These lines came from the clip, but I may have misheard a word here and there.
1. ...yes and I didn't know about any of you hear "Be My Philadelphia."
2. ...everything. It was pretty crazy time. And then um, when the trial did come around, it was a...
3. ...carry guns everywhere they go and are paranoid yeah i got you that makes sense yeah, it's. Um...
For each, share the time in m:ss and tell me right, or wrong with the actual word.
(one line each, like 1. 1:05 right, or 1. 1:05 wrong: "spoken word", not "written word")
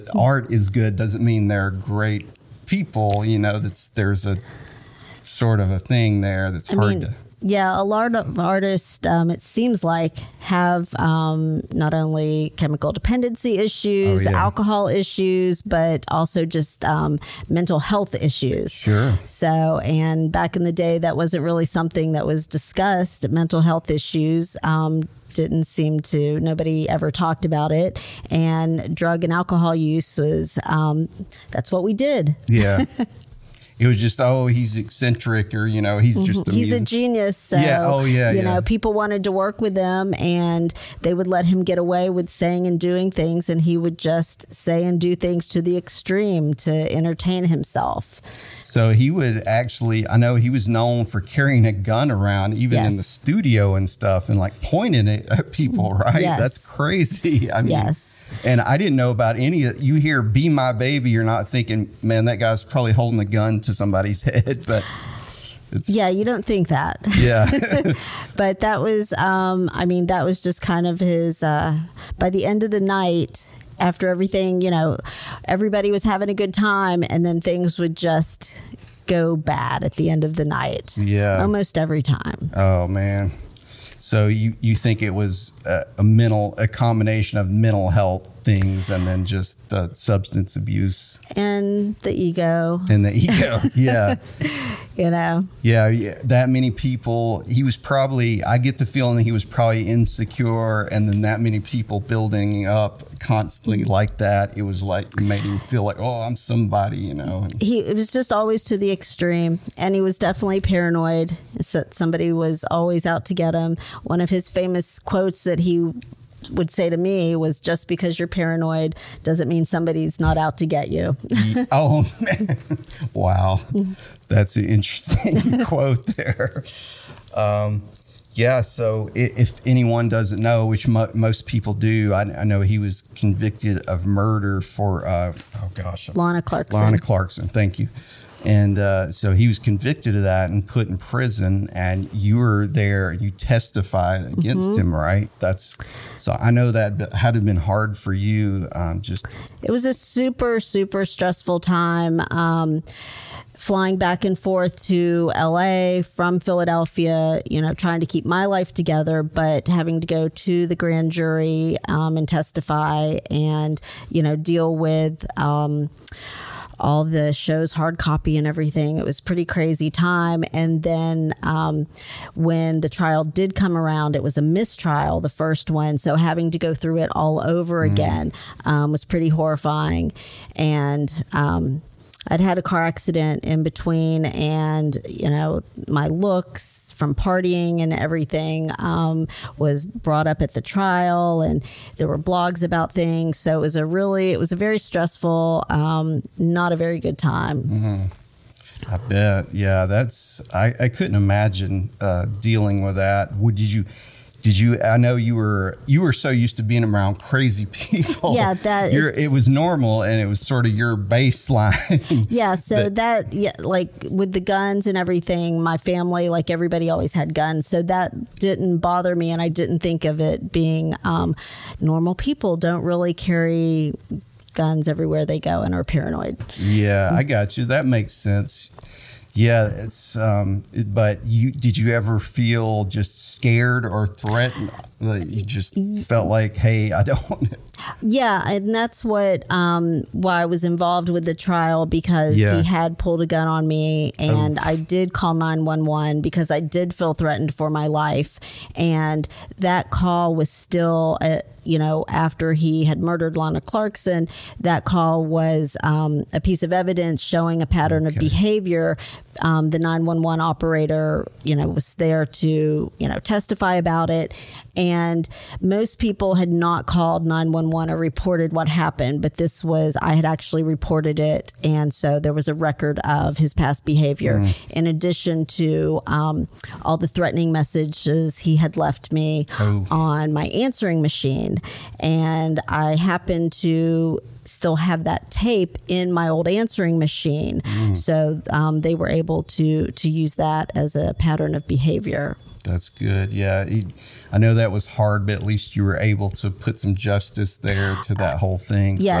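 1. 0:57 wrong: "Baby", not "Philadelphia"
2. 2:48 right
3. 3:43 right.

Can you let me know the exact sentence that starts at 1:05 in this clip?
It's, yeah, you don't think that.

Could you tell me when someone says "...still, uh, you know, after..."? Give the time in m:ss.
4:10.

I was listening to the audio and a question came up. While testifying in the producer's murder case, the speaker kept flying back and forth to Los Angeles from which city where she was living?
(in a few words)
Philadelphia.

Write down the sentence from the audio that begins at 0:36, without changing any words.
he's a genius so, yeah oh yeah you yeah.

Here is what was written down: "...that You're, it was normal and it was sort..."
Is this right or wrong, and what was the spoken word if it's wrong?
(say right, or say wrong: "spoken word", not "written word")
right.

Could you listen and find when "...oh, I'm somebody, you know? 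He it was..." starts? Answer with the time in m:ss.
1:45.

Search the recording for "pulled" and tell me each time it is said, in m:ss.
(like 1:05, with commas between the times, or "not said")
4:02.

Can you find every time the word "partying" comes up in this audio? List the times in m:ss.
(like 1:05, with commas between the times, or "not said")
3:07.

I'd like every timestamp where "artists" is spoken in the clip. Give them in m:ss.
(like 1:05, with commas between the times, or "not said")
0:08.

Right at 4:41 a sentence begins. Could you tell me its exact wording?
And I happened to still have that tape in my old answering machine.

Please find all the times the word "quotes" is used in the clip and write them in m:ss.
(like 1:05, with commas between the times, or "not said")
1:54, 2:05.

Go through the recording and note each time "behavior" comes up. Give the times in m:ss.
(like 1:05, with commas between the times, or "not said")
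4:18, 4:33, 4:51.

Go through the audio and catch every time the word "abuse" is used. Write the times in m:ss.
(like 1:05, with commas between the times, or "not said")
1:30.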